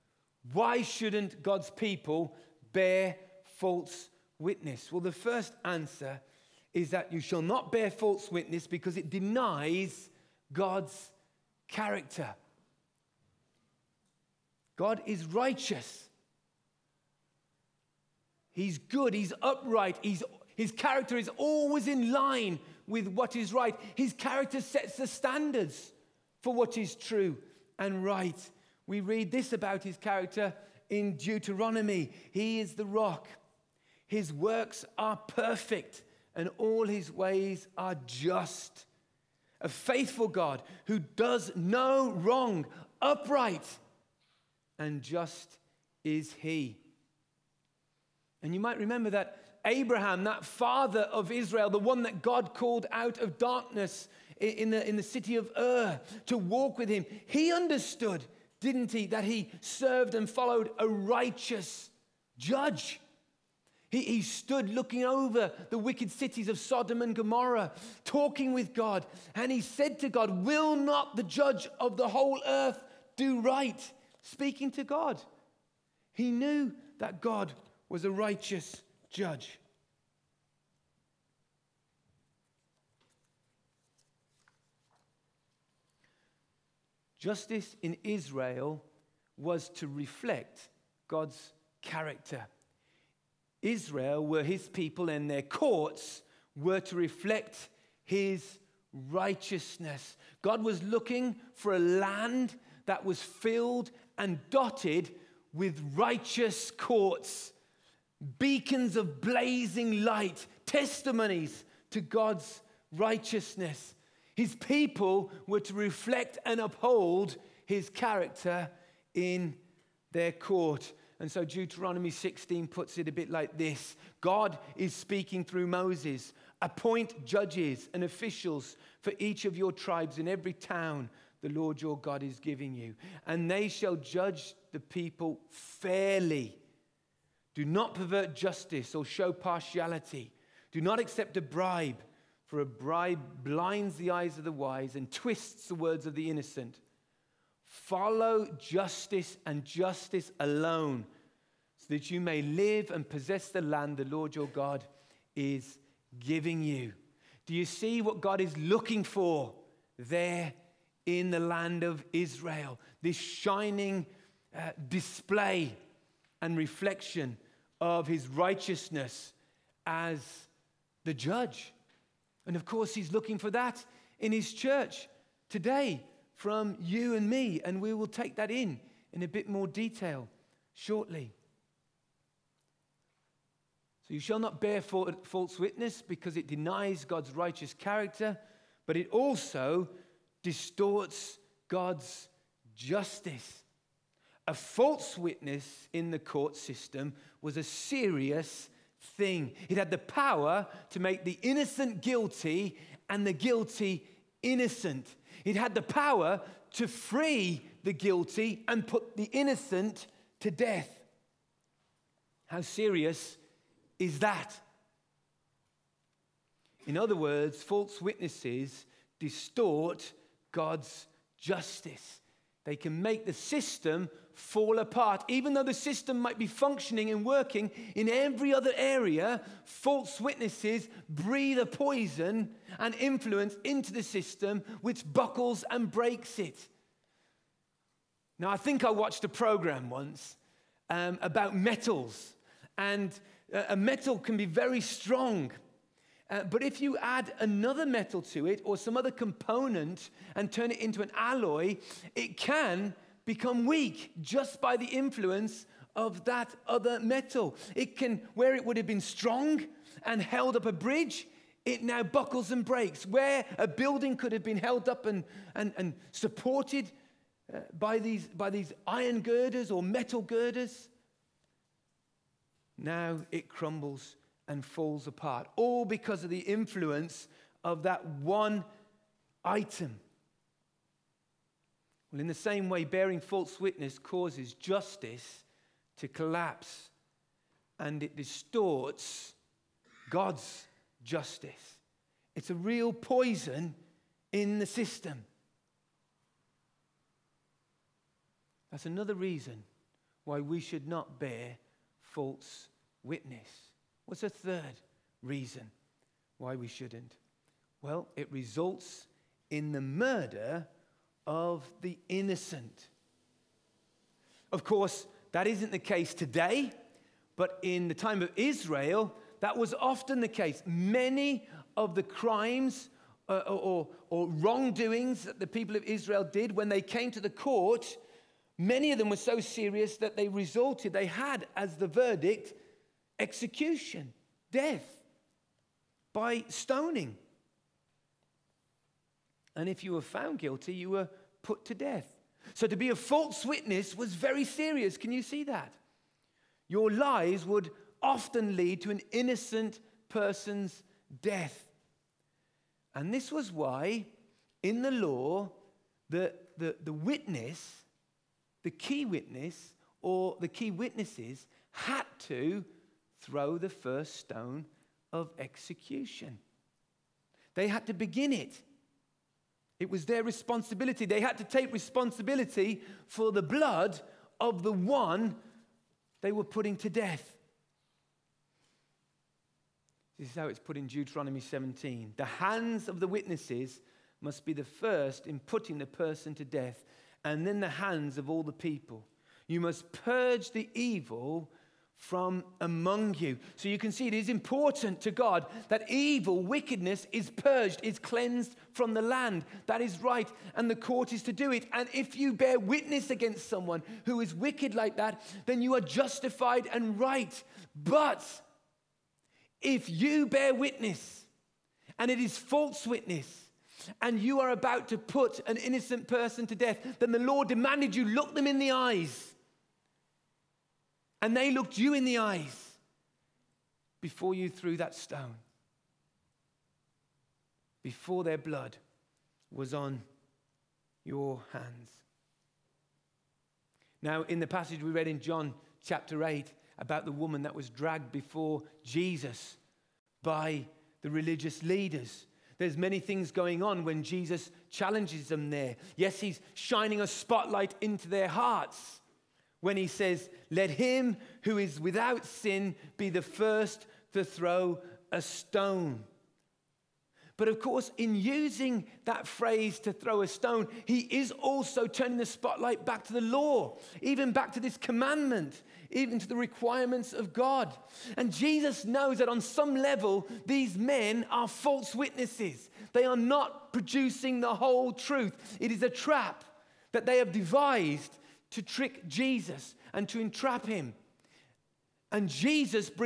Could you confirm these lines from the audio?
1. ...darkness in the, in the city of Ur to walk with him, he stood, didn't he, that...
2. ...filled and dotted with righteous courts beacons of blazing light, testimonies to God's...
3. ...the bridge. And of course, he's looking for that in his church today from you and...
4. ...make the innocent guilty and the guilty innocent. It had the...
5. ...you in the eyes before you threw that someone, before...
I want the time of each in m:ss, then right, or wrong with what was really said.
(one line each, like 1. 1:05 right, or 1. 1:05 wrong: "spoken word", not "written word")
1. 0:53 wrong: "understood", not "stood"
2. 1:43 right
3. 2:51 wrong: "judge", not "bridge"
4. 3:20 right
5. 7:01 wrong: "stone", not "someone".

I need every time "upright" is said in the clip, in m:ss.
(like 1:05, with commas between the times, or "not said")
0:19, 0:43.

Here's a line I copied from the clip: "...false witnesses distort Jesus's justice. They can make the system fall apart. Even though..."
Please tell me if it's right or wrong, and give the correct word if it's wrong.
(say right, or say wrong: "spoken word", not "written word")
wrong: "God", not "Jesus".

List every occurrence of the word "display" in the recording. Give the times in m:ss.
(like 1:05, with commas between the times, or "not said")
2:44.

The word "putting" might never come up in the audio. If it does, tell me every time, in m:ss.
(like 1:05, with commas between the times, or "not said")
6:16, 6:25.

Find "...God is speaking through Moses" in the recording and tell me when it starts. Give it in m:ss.
2:04.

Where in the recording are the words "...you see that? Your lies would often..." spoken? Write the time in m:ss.
5:45.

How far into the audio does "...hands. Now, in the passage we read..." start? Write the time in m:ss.
7:11.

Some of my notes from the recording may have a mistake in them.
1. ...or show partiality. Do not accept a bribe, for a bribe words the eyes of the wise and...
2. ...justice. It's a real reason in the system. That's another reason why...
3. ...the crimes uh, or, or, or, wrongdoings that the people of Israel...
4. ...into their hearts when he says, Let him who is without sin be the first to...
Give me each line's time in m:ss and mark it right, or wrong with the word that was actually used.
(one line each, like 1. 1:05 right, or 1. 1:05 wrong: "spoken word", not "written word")
1. 2:18 wrong: "blinds", not "words"
2. 4:51 wrong: "poison", not "reason"
3. 5:21 right
4. 7:27 right.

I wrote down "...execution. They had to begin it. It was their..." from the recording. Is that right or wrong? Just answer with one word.
right.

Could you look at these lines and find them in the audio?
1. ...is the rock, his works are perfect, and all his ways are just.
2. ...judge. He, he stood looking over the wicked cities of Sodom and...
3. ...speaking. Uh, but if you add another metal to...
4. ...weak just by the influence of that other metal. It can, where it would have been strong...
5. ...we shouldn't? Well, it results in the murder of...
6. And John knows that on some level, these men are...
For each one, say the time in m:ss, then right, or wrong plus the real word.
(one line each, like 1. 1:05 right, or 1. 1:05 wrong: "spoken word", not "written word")
1. 0:32 right
2. 1:02 right
3. 4:04 wrong: "strong", not "speaking"
4. 4:13 right
5. 5:06 right
6. 7:48 wrong: "Jesus", not "John".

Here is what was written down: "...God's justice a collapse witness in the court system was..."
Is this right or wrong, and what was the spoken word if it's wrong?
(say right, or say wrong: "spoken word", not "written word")
wrong: "false", not "collapse".